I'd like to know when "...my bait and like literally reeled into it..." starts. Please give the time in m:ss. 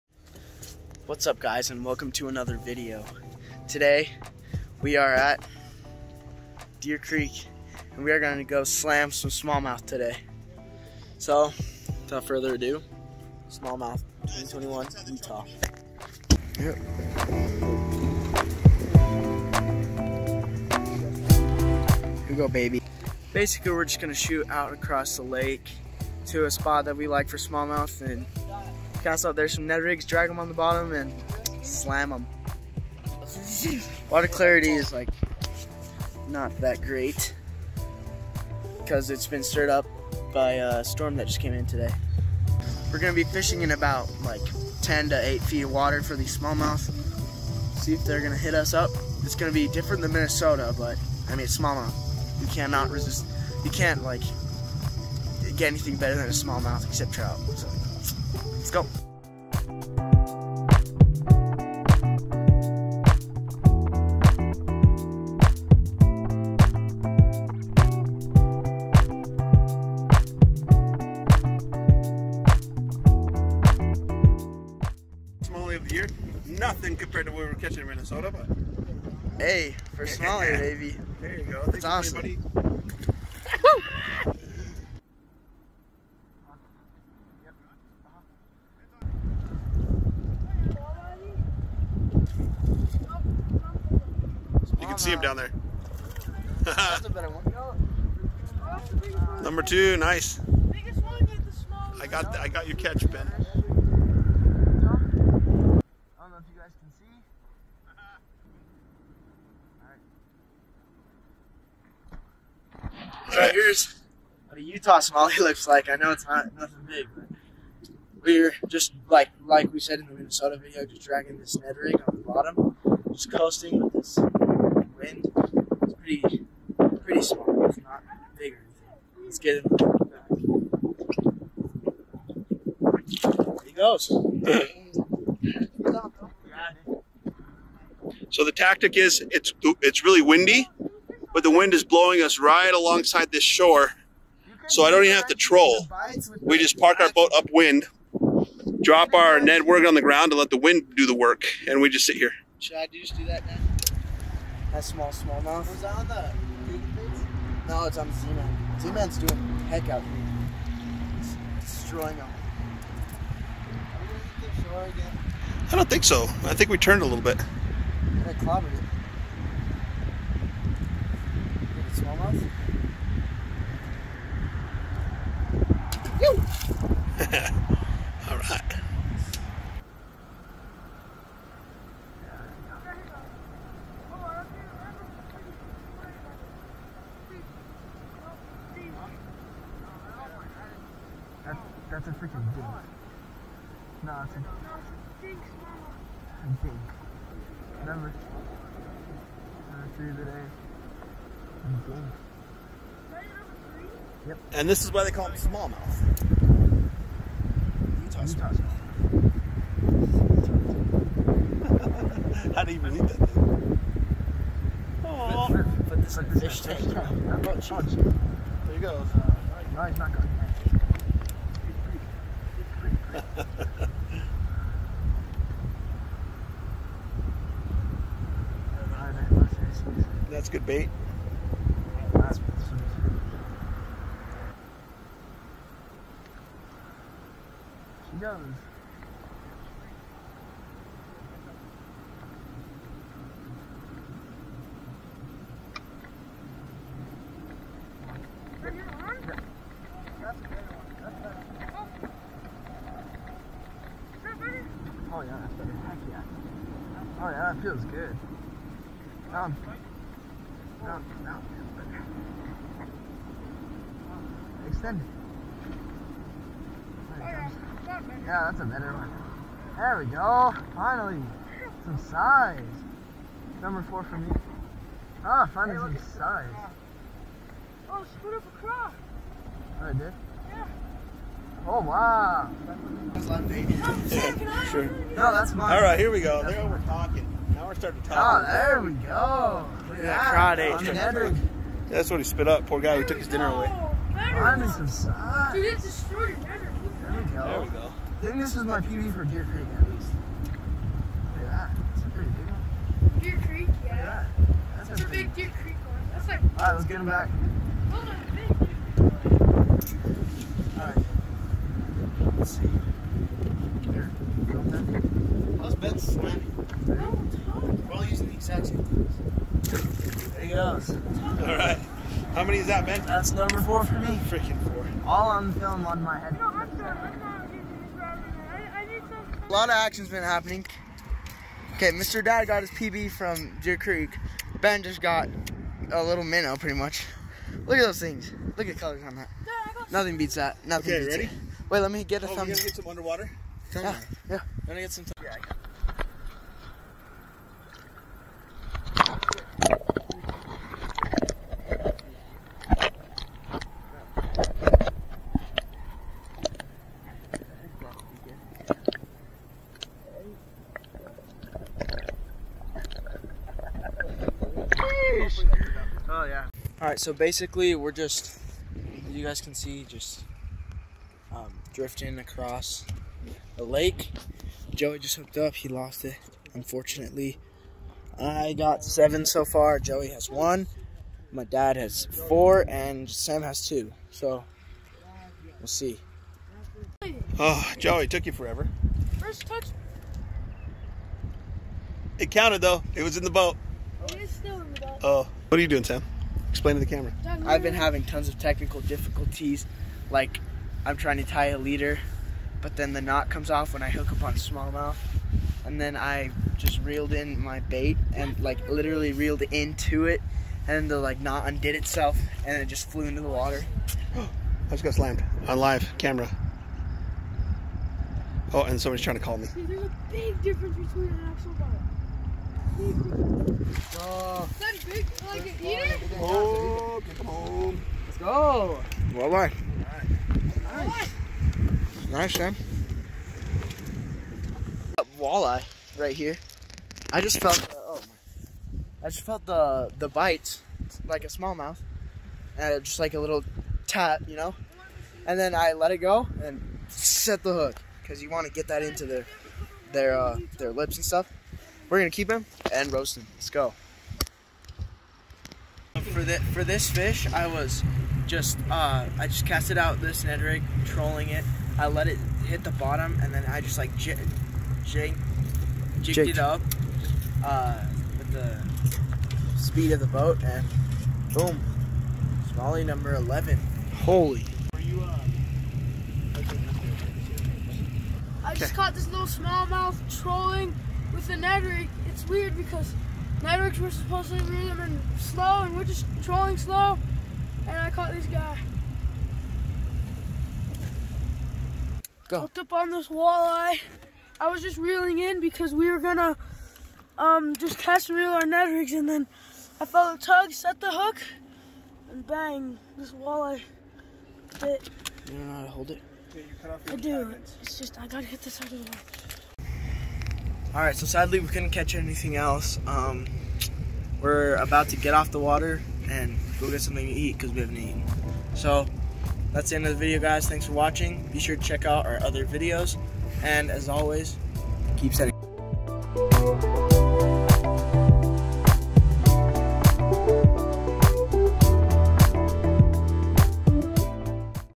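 6:47.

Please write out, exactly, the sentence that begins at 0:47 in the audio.
See if they're gonna hit us up.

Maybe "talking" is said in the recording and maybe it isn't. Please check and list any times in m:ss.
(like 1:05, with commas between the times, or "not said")
4:46.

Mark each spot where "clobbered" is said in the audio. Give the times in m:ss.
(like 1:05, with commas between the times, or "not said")
2:48.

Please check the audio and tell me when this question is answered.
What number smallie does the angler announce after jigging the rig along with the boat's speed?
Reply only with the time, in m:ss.
7:53.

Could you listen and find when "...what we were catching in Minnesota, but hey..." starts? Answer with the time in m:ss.
1:17.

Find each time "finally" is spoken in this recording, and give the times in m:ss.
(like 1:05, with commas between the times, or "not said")
4:30, 4:35.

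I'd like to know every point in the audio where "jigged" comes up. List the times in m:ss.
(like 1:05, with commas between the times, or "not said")
7:46.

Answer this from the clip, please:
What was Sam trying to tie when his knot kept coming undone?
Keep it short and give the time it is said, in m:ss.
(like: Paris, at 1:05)
A leader, at 6:41.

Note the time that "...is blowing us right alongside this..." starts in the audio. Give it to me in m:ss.
2:21.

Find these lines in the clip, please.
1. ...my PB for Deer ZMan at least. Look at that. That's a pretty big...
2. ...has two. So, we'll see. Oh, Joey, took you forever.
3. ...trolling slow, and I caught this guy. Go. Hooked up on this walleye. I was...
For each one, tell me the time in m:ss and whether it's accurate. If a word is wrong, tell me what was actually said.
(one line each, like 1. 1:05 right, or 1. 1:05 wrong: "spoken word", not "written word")
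1. 4:58 wrong: "Creek", not "ZMan"
2. 6:23 right
3. 8:06 right.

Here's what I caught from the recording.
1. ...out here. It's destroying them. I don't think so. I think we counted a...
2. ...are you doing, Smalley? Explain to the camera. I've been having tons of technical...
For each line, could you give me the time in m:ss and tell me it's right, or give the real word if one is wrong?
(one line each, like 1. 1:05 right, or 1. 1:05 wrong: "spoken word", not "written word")
1. 2:39 wrong: "turned", not "counted"
2. 6:35 wrong: "Sam", not "Smalley".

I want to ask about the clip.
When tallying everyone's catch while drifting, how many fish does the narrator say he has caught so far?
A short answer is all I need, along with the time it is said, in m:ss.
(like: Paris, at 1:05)
7, at 6:18.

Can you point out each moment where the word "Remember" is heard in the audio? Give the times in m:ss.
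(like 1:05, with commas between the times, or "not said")
3:17.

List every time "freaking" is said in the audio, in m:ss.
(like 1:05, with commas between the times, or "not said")
3:12, 5:24.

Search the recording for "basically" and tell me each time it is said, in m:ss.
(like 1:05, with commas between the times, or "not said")
0:23, 6:07.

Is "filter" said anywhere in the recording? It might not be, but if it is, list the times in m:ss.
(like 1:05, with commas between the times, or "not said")
not said.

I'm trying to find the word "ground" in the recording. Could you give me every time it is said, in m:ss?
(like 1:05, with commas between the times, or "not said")
2:30.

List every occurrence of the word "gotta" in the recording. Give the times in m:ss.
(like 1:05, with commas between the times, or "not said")
5:42, 8:28.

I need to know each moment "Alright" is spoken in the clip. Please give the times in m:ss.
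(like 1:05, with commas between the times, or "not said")
5:06, 8:30.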